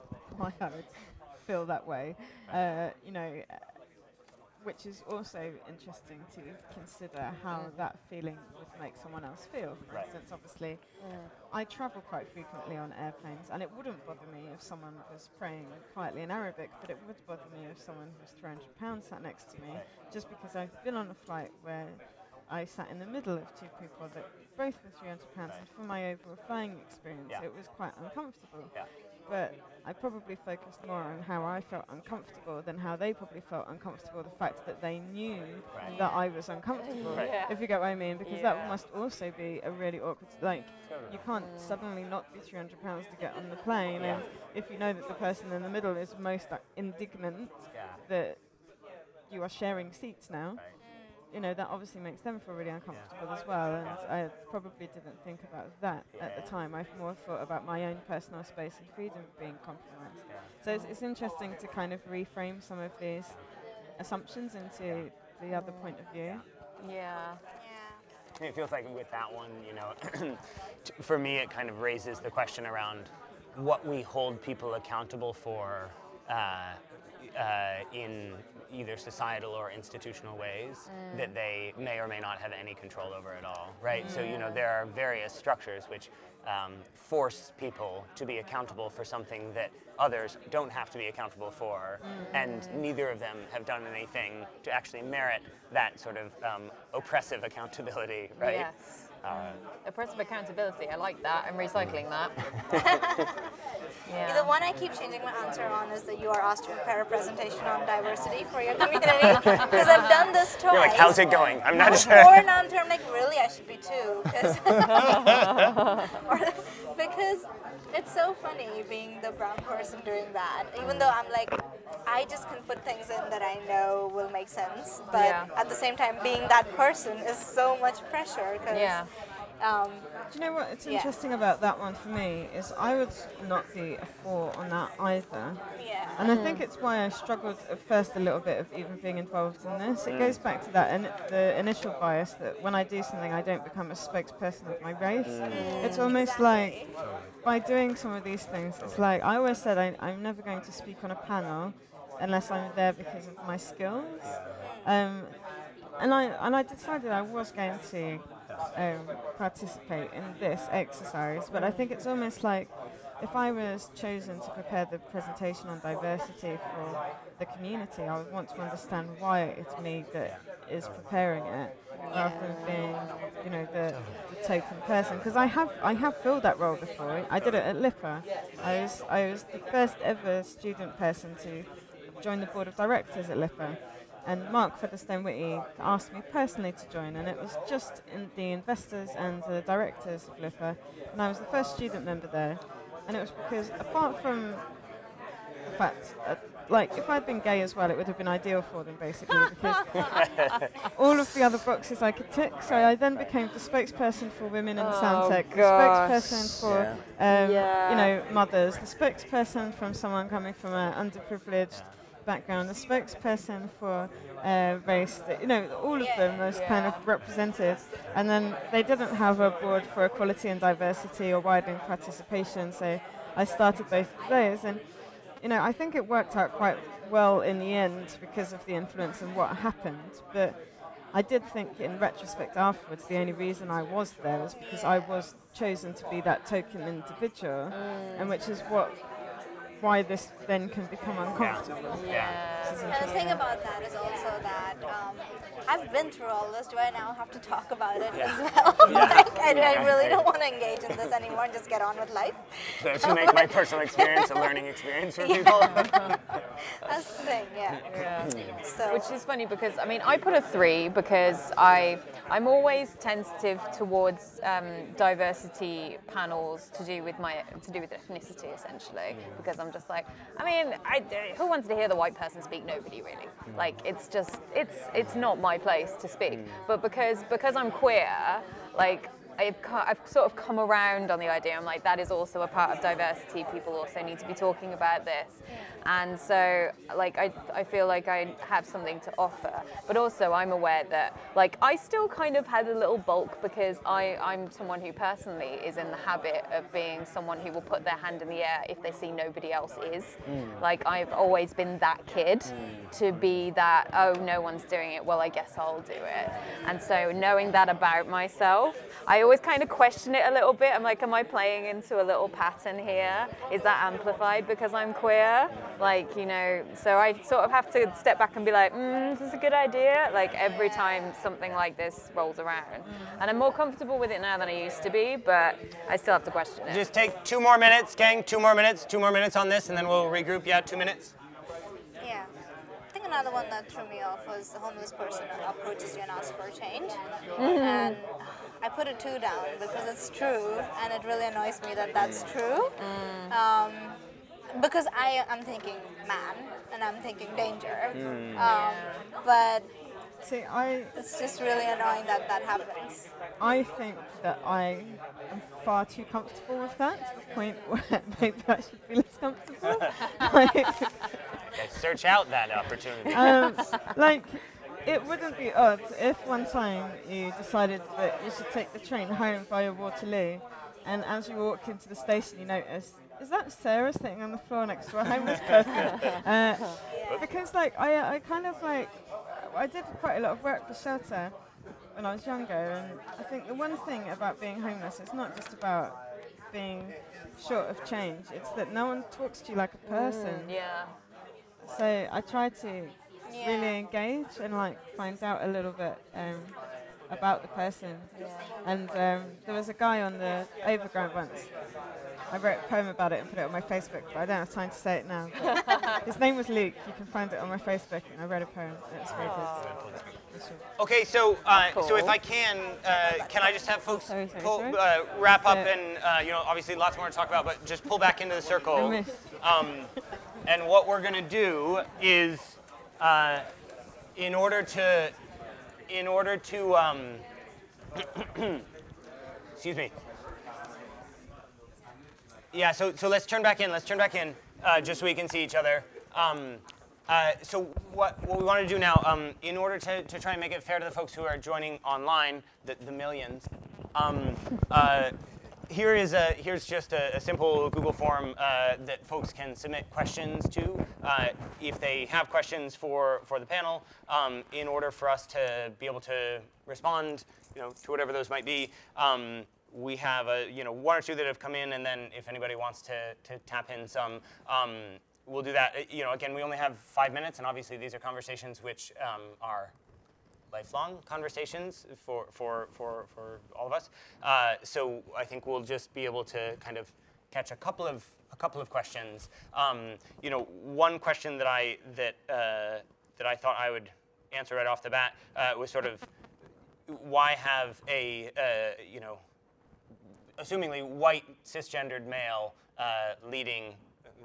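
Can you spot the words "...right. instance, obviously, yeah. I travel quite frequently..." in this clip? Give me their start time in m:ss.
0:09.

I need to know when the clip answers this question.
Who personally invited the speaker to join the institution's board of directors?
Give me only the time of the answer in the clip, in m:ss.
3:04.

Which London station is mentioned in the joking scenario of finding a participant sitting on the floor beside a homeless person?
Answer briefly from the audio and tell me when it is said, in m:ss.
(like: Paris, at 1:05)
Waterloo, at 6:09.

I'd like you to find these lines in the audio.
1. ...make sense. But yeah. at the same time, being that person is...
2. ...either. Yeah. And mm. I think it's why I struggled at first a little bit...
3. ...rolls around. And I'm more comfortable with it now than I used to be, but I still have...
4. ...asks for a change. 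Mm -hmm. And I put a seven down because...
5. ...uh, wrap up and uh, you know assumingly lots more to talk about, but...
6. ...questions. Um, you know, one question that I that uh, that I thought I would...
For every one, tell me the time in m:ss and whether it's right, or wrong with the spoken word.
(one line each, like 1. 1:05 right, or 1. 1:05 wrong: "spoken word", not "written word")
1. 2:04 right
2. 2:14 right
3. 5:22 right
4. 5:36 wrong: "two", not "seven"
5. 6:54 wrong: "obviously", not "assumingly"
6. 7:58 right.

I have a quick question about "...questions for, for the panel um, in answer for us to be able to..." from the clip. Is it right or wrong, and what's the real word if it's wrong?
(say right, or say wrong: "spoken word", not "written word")
wrong: "order", not "answer".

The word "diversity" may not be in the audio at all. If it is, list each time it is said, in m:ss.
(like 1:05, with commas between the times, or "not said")
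1:47, 2:45, 3:40, 4:24, 4:42.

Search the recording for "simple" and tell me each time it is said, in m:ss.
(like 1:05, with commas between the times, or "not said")
7:27.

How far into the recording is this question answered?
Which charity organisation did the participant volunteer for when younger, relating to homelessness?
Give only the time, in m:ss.
6:20.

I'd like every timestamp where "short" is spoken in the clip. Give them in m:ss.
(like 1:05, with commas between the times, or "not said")
6:27.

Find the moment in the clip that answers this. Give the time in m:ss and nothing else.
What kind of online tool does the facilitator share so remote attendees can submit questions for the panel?
7:27.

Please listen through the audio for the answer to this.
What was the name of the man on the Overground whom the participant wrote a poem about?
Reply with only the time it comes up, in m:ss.
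6:46.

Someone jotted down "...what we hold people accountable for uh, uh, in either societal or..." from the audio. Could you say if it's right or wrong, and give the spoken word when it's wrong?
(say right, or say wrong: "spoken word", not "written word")
right.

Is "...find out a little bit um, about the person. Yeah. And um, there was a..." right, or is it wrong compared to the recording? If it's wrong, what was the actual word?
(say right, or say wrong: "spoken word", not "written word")
right.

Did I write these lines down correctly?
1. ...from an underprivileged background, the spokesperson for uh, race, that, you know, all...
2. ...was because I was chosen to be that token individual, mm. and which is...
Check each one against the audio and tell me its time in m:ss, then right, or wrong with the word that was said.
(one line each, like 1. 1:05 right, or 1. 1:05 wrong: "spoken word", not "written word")
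1. 3:30 right
2. 3:54 right.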